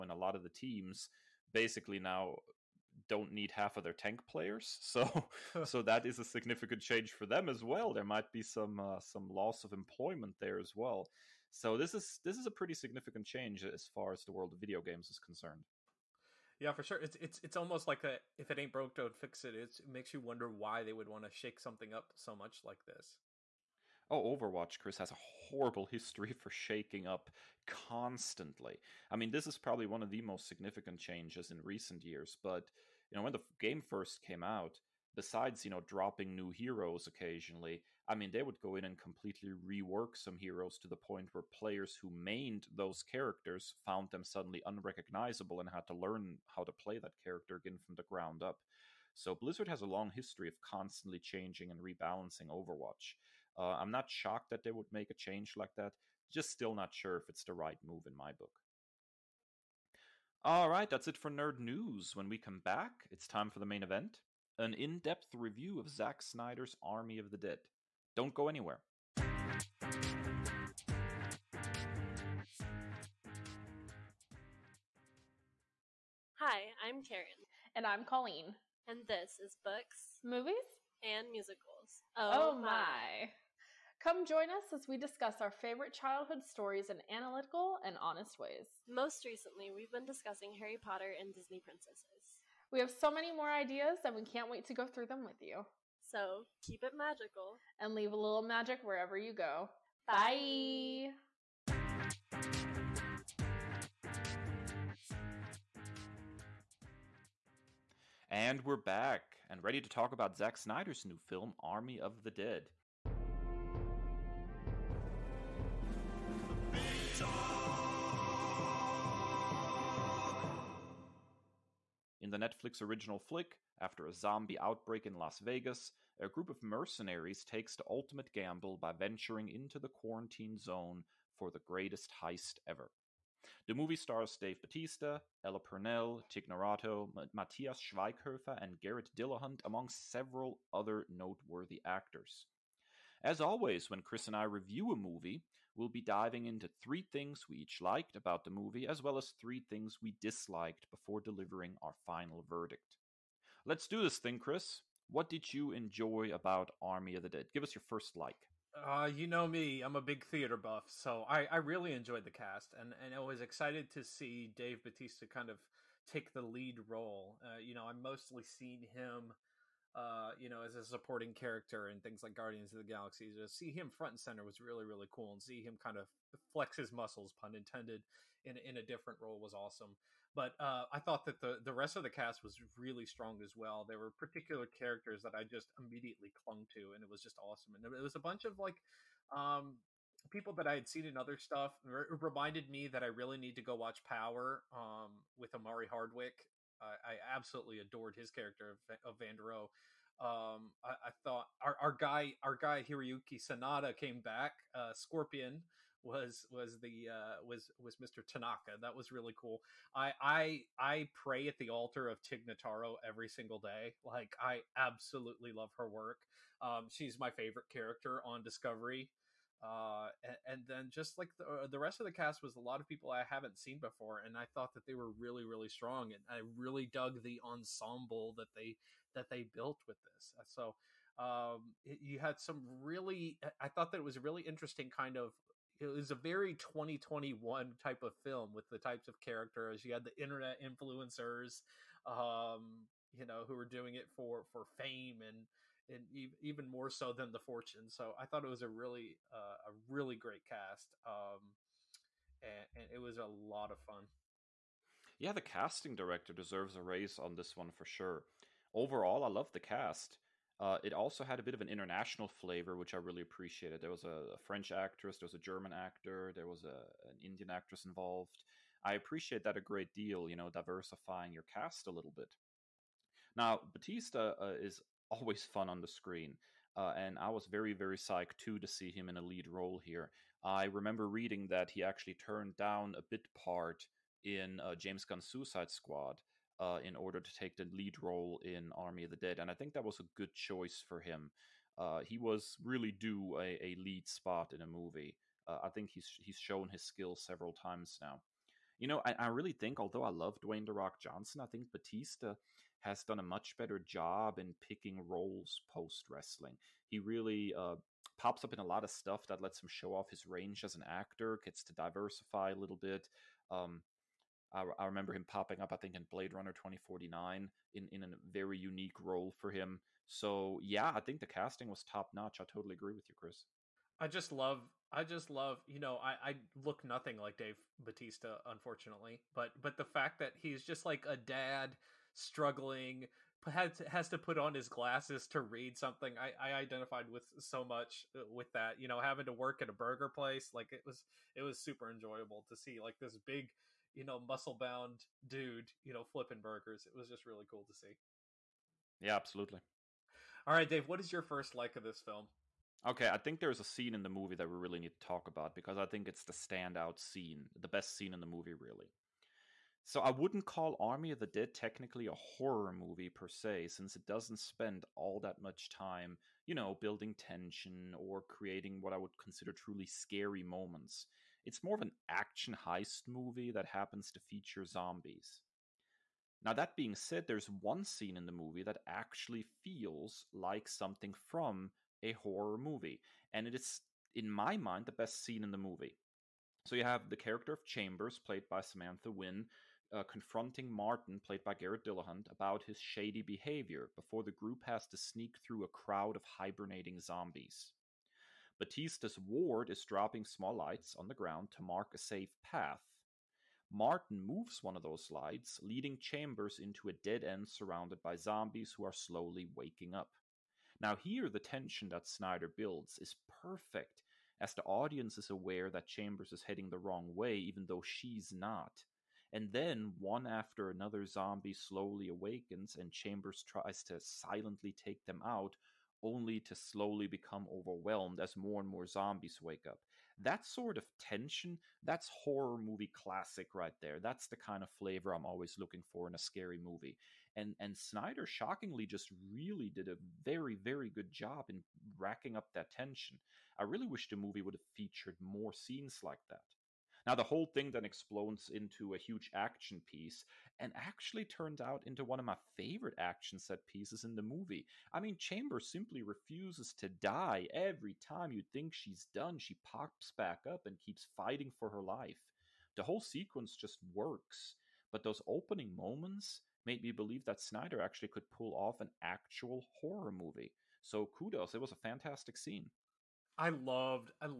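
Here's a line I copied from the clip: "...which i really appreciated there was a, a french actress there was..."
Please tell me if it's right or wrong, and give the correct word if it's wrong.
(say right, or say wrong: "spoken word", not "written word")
right.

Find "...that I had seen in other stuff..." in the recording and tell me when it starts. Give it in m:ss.
3:10.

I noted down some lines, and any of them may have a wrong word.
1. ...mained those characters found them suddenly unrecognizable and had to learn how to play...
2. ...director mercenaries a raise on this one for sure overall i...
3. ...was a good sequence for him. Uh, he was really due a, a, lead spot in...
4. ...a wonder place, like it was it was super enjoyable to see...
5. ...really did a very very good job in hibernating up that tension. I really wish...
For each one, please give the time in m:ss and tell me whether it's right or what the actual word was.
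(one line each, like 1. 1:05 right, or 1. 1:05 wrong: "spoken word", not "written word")
1. 0:42 right
2. 4:15 wrong: "deserves", not "mercenaries"
3. 4:49 wrong: "choice", not "sequence"
4. 5:39 wrong: "burger", not "wonder"
5. 7:19 wrong: "racking", not "hibernating".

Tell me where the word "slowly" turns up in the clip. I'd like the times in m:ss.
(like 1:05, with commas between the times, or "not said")
6:48, 7:01, 7:06.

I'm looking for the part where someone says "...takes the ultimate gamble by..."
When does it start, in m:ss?
2:07.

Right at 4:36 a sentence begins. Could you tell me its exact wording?
Uh, and I was very, very psyched too to see him in a lead role here.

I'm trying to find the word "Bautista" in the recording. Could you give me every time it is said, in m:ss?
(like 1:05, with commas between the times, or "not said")
2:14, 2:44, 4:33, 5:01, 5:27, 6:38.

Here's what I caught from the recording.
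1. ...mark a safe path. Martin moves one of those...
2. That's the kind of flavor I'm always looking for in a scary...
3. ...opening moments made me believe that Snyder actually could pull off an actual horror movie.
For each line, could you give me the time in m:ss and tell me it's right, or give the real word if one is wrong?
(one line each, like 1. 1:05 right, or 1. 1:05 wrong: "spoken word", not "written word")
1. 6:41 right
2. 7:13 right
3. 7:45 right.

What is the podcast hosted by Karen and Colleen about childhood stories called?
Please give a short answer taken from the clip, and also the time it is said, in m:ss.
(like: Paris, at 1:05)
Books, Movies, and Musicals, at 1:19.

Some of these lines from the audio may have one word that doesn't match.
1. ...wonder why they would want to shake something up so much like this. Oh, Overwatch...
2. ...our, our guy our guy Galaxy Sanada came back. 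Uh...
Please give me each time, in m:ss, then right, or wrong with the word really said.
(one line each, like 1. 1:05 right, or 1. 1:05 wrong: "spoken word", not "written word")
1. 0:20 right
2. 3:21 wrong: "Hiroyuki", not "Galaxy".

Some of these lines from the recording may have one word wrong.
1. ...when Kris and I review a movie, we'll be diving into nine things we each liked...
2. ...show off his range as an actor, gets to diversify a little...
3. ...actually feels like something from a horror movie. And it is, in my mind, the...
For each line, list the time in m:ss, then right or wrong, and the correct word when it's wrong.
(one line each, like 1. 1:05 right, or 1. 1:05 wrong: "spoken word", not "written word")
1. 2:23 wrong: "three", not "nine"
2. 5:09 right
3. 6:18 right.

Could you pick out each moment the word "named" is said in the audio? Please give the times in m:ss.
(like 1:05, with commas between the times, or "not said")
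not said.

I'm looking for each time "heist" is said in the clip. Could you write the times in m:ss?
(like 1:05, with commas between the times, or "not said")
2:12, 6:12.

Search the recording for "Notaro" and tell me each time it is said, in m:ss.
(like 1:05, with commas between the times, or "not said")
2:16, 3:32.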